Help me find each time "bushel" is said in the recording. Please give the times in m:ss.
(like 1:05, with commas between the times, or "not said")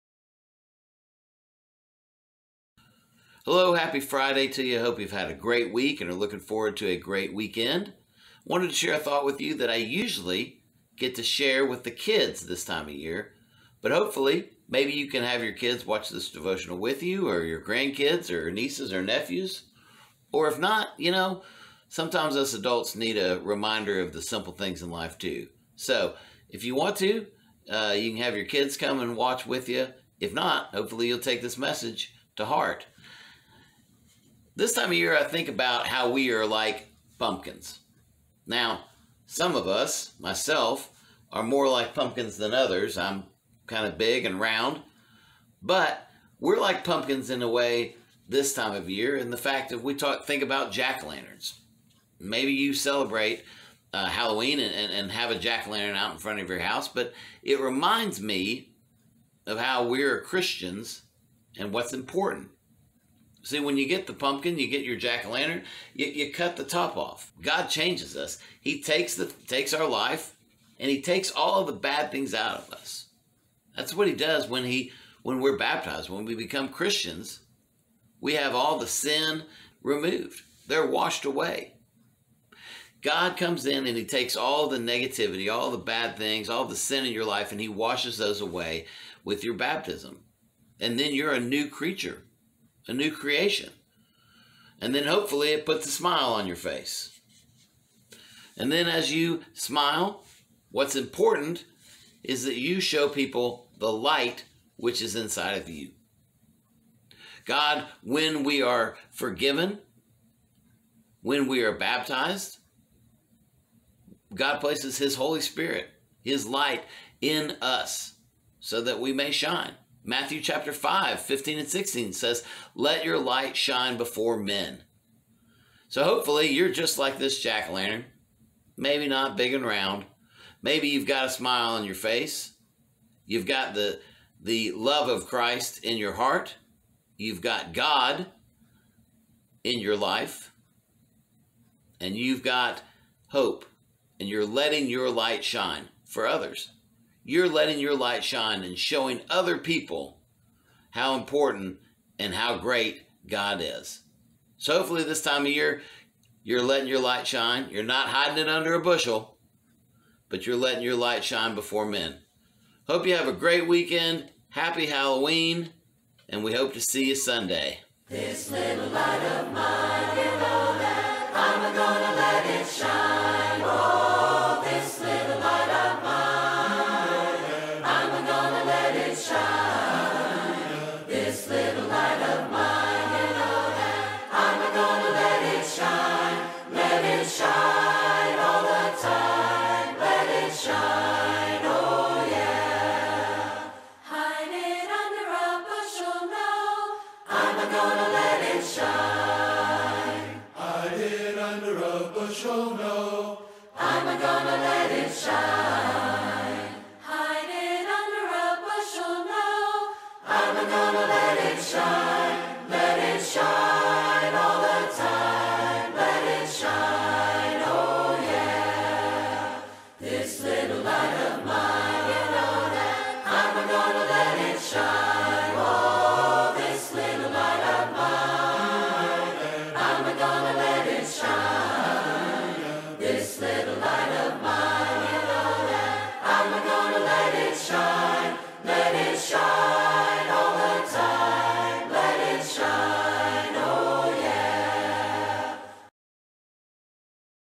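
2:38, 3:28.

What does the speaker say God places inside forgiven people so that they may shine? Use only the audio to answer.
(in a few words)
His Holy Spirit.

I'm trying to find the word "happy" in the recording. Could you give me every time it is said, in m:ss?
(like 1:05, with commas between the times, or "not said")
0:03, 2:44.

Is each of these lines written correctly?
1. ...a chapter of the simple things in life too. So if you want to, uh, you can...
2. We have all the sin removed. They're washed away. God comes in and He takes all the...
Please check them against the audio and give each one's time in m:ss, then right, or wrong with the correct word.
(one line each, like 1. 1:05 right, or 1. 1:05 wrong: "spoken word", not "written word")
1. 0:23 wrong: "reminder", not "chapter"
2. 1:18 right.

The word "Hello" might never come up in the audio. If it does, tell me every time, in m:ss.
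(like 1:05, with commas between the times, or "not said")
0:03.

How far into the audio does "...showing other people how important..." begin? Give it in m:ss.
2:28.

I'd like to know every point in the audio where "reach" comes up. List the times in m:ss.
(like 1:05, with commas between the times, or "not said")
not said.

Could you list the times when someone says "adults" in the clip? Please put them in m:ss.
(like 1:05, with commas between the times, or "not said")
0:22.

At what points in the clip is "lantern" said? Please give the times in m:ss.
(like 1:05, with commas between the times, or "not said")
0:51, 0:55, 1:05, 2:07.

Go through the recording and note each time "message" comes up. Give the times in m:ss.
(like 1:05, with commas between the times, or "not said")
0:31.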